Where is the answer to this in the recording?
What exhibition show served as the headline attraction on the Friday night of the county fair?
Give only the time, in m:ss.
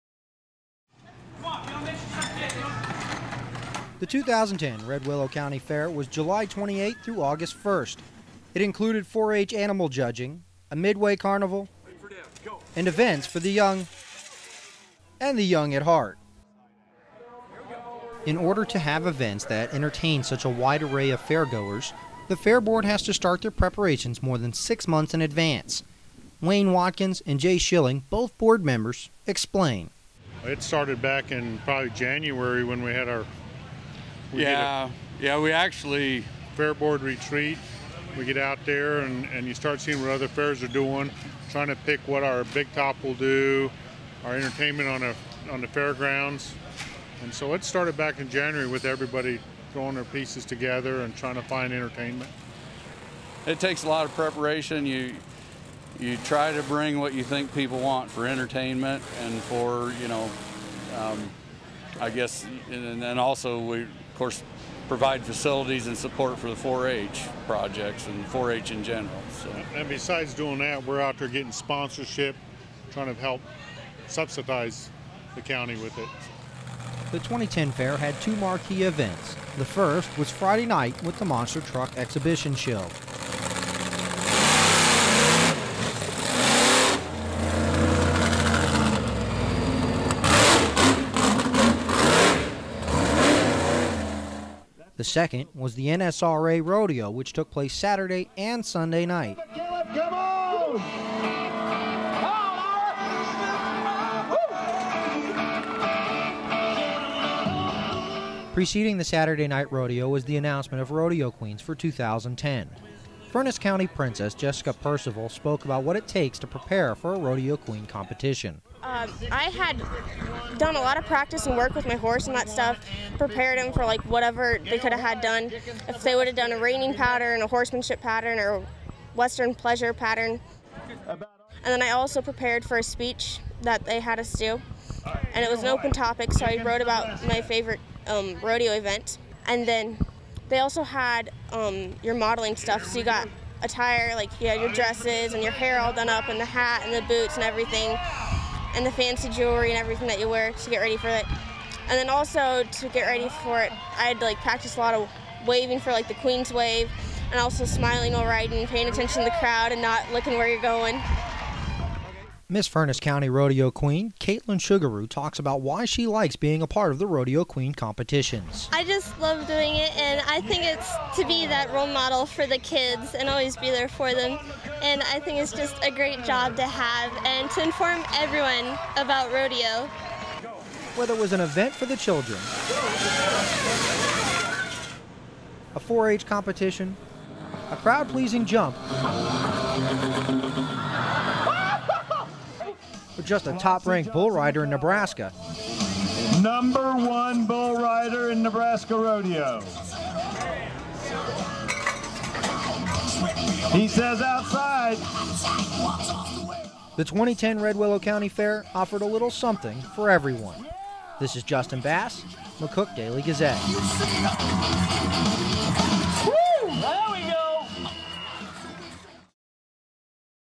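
1:21.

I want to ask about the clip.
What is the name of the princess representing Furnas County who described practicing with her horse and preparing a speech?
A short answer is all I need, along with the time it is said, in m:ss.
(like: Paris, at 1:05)
Jessica Percival, at 1:54.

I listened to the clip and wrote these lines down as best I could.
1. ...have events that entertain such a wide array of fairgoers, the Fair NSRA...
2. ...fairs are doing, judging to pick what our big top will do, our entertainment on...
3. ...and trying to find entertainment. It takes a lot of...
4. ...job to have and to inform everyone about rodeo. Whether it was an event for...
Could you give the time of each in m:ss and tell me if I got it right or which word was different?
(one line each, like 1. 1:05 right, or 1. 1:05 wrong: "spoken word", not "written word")
1. 0:18 wrong: "Board", not "NSRA"
2. 0:40 wrong: "trying", not "judging"
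3. 0:51 right
4. 2:56 right.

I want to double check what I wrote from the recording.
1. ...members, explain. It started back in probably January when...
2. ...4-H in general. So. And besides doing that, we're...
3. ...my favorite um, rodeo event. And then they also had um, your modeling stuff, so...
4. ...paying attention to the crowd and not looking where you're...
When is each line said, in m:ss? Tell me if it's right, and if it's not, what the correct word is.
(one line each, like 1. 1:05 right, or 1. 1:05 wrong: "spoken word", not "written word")
1. 0:28 right
2. 1:08 right
3. 2:17 right
4. 2:38 right.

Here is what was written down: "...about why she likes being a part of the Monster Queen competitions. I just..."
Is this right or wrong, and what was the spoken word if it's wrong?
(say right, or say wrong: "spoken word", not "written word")
wrong: "Rodeo", not "Monster".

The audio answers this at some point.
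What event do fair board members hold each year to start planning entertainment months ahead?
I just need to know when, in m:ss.
0:36.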